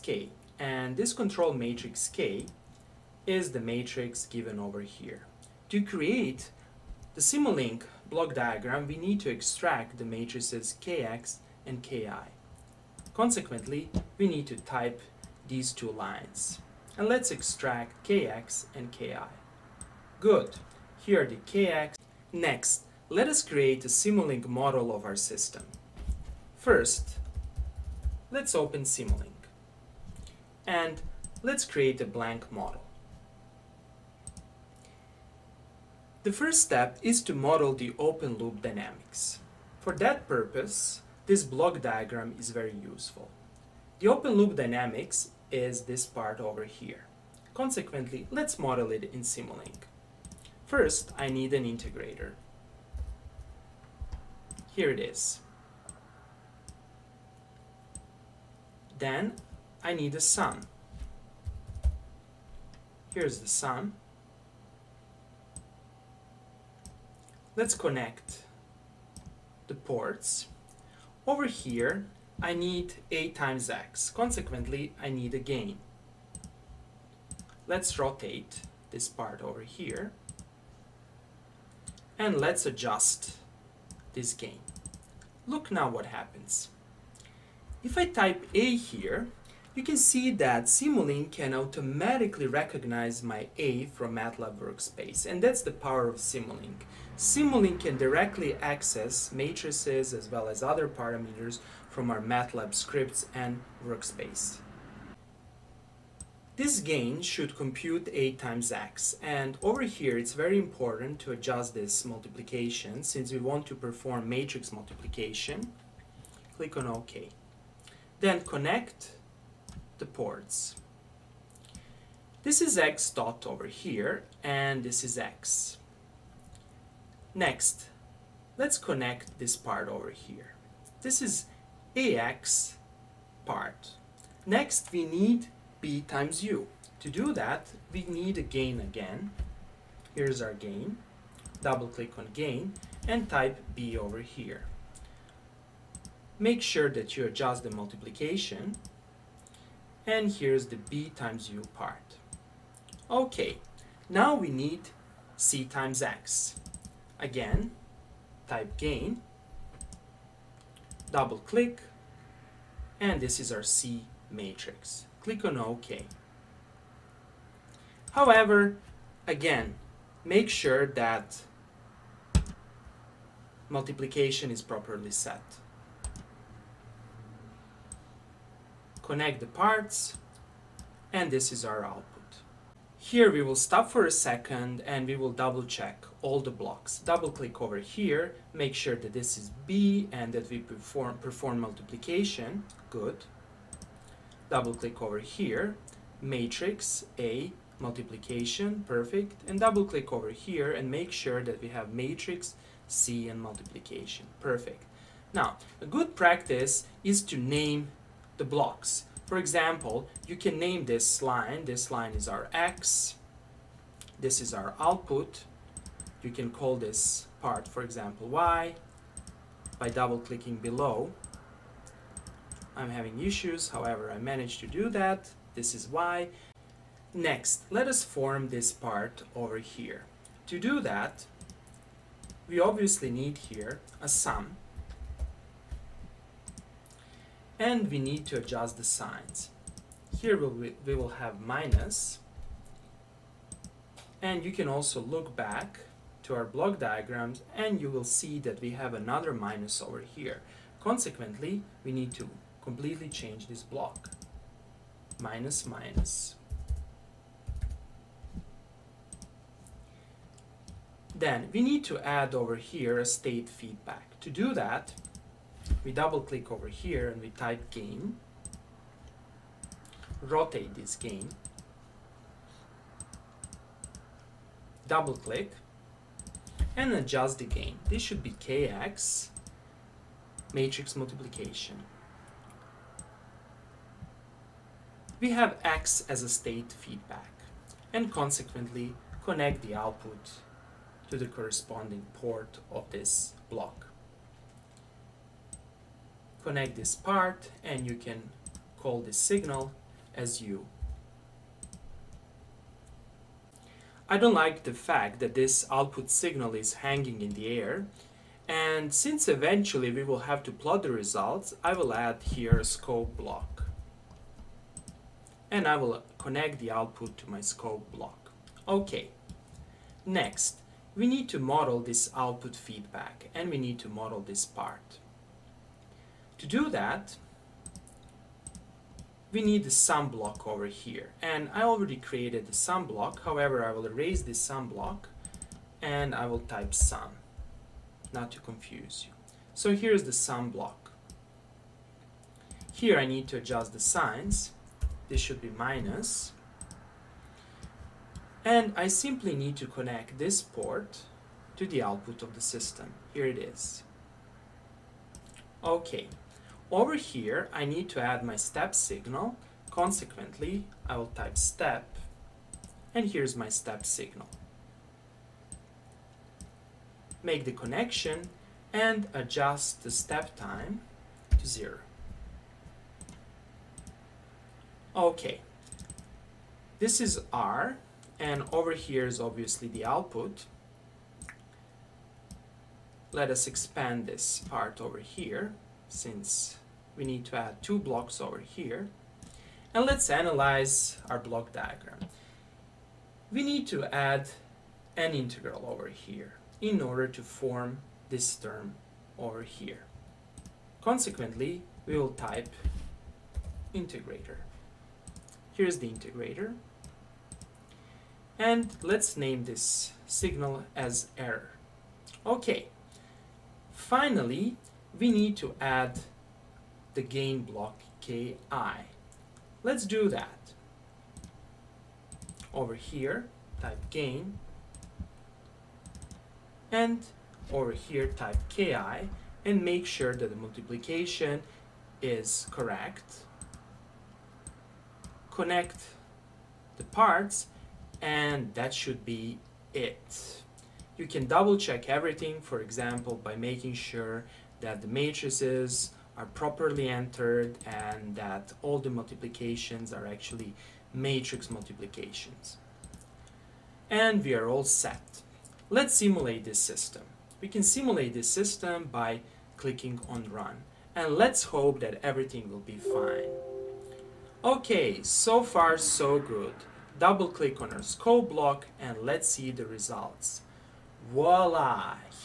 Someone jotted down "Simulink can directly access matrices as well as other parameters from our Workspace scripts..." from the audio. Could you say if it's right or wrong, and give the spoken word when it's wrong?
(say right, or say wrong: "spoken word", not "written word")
wrong: "MATLAB", not "Workspace".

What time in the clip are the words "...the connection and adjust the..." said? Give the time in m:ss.
6:07.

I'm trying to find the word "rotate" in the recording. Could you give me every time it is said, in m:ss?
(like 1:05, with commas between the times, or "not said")
1:17, 4:30.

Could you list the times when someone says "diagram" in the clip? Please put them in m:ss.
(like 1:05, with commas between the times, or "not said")
0:08, 0:41, 4:06, 6:31.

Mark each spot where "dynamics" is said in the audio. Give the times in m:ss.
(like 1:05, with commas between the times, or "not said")
0:38, 0:44.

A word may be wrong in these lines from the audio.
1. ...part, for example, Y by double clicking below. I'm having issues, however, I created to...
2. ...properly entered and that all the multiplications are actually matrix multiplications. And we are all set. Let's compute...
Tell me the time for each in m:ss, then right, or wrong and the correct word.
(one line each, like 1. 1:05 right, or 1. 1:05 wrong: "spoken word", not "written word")
1. 3:37 wrong: "managed", not "created"
2. 7:26 wrong: "simulate", not "compute".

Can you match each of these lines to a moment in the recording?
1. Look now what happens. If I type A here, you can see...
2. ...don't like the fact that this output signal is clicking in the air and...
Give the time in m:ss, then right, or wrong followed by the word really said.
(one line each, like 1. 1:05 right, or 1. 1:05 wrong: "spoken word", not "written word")
1. 1:25 right
2. 5:04 wrong: "hanging", not "clicking".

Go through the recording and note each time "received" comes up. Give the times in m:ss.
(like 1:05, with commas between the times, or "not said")
not said.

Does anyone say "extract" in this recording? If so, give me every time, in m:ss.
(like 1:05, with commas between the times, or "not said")
0:09, 0:17.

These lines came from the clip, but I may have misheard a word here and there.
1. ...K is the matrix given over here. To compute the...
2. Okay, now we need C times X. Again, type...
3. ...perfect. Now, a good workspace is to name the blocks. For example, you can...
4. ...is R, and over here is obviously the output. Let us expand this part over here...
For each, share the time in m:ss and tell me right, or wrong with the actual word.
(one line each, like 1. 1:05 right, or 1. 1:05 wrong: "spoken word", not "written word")
1. 0:02 wrong: "create", not "compute"
2. 2:33 right
3. 3:24 wrong: "practice", not "workspace"
4. 6:17 right.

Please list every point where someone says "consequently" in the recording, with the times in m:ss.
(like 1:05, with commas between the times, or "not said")
0:13, 0:47, 1:14, 4:10, 4:48, 5:59, 6:40.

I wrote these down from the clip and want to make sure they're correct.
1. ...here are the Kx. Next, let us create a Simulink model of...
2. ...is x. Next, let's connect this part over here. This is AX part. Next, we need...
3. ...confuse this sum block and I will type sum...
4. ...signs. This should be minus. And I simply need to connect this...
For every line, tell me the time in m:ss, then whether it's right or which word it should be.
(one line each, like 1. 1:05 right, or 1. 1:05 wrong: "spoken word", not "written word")
1. 0:21 right
2. 2:05 right
3. 5:33 wrong: "erase", not "confuse"
4. 5:43 right.